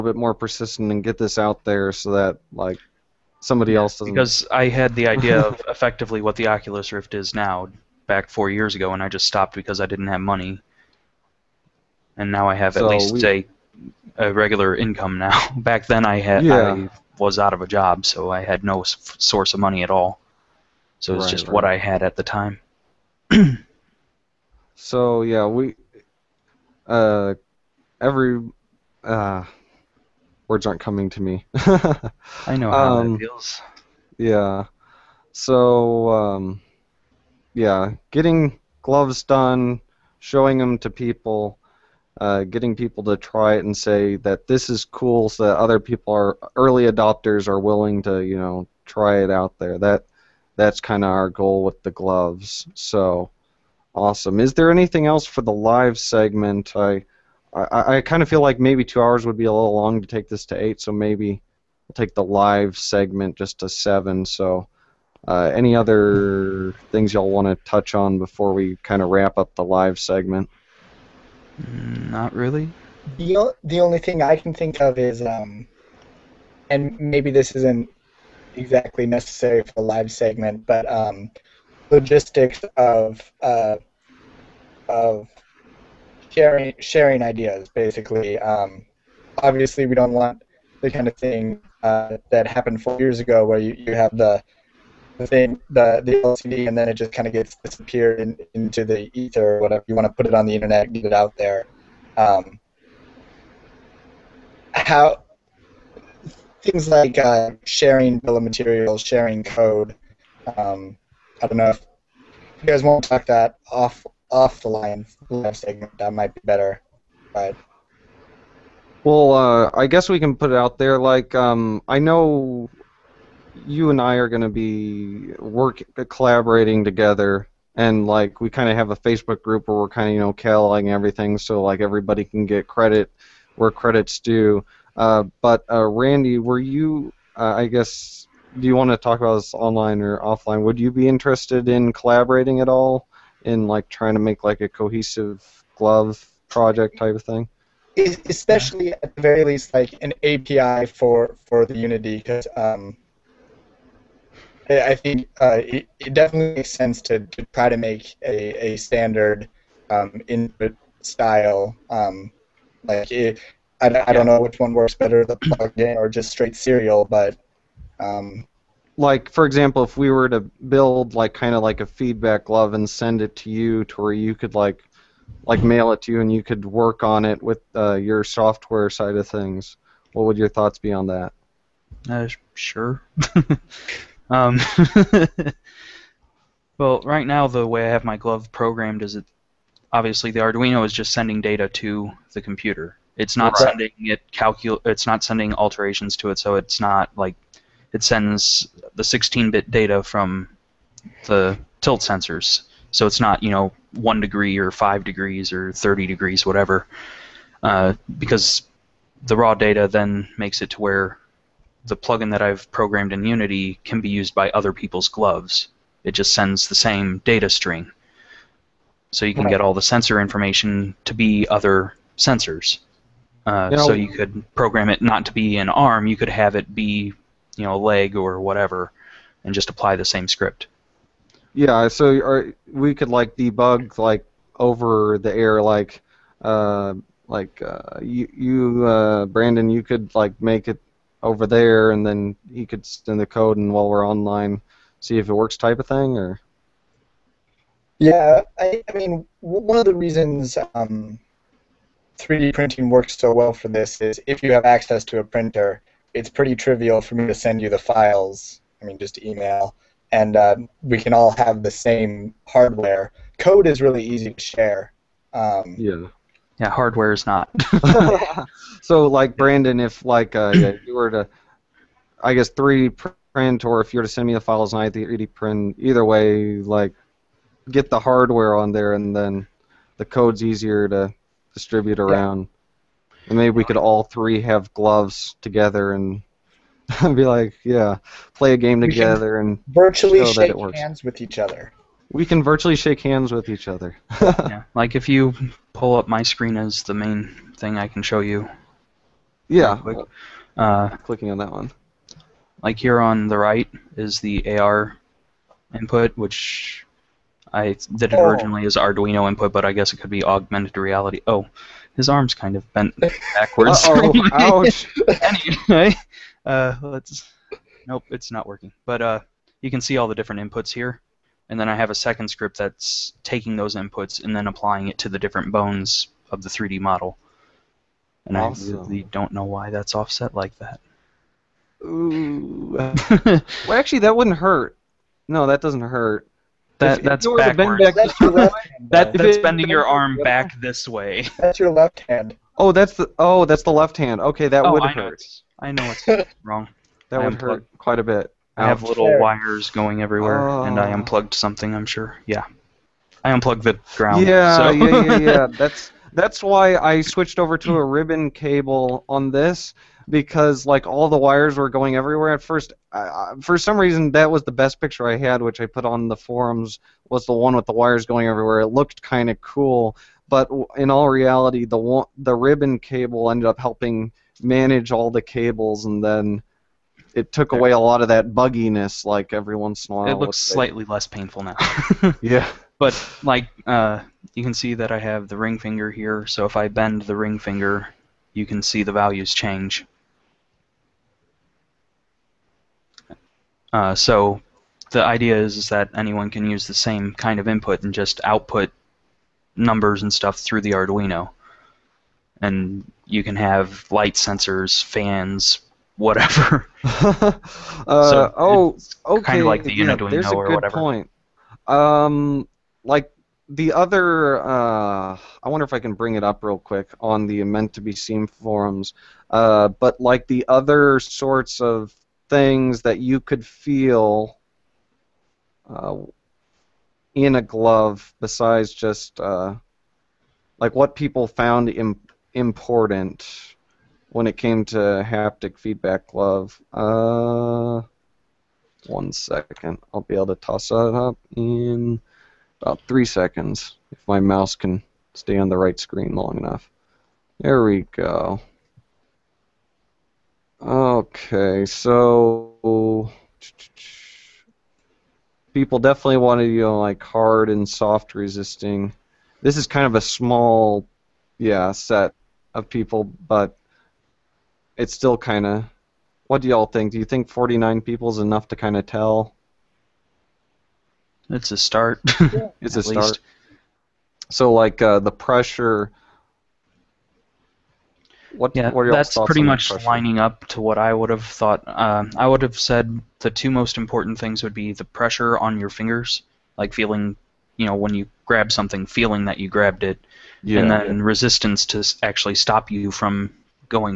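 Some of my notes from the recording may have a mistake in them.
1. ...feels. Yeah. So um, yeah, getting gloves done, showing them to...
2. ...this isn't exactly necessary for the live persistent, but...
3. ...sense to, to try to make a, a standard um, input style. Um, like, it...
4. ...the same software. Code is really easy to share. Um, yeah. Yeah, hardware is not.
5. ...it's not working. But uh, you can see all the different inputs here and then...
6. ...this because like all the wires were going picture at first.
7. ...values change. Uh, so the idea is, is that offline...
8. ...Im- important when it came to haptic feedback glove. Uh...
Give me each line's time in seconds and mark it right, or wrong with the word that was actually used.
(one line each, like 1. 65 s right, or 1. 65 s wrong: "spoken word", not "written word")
1. 33 s right
2. 77 s wrong: "segment", not "persistent"
3. 156 s right
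4. 261 s wrong: "hardware", not "software"
5. 318 s right
6. 359 s wrong: "everywhere", not "picture"
7. 388 s wrong: "anyone", not "offline"
8. 431 s right.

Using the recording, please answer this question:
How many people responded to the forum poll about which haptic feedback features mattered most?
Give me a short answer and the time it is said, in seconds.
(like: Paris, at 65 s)
49, at 467 s.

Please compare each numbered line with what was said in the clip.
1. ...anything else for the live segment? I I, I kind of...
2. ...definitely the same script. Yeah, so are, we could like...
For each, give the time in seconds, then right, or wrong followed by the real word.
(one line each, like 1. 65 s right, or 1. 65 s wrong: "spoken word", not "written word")
1. 54 s right
2. 229 s wrong: "apply", not "definitely".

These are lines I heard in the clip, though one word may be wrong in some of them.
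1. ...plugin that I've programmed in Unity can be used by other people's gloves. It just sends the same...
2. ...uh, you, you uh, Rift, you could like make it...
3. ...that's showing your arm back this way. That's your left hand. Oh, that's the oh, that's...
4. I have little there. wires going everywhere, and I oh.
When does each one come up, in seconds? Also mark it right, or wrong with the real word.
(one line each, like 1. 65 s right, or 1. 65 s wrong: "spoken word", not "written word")
1. 211 s right
2. 237 s wrong: "Brandon", not "Rift"
3. 339 s wrong: "bending", not "showing"
4. 348 s right.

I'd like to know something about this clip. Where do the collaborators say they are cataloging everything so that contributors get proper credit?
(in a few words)
Facebook group.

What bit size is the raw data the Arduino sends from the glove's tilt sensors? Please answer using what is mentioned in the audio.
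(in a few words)
16-bit.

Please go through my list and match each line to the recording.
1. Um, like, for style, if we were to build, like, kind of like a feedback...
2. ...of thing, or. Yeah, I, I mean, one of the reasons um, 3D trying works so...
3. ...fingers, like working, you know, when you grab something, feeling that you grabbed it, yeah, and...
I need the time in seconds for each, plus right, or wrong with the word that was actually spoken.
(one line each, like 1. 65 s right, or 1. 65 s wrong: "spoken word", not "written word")
1. 167 s wrong: "example", not "style"
2. 245 s wrong: "printing", not "trying"
3. 485 s wrong: "feeling", not "working".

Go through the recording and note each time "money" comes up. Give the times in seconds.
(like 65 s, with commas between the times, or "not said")
10 s, 19 s.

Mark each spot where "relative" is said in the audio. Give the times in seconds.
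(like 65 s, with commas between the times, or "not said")
not said.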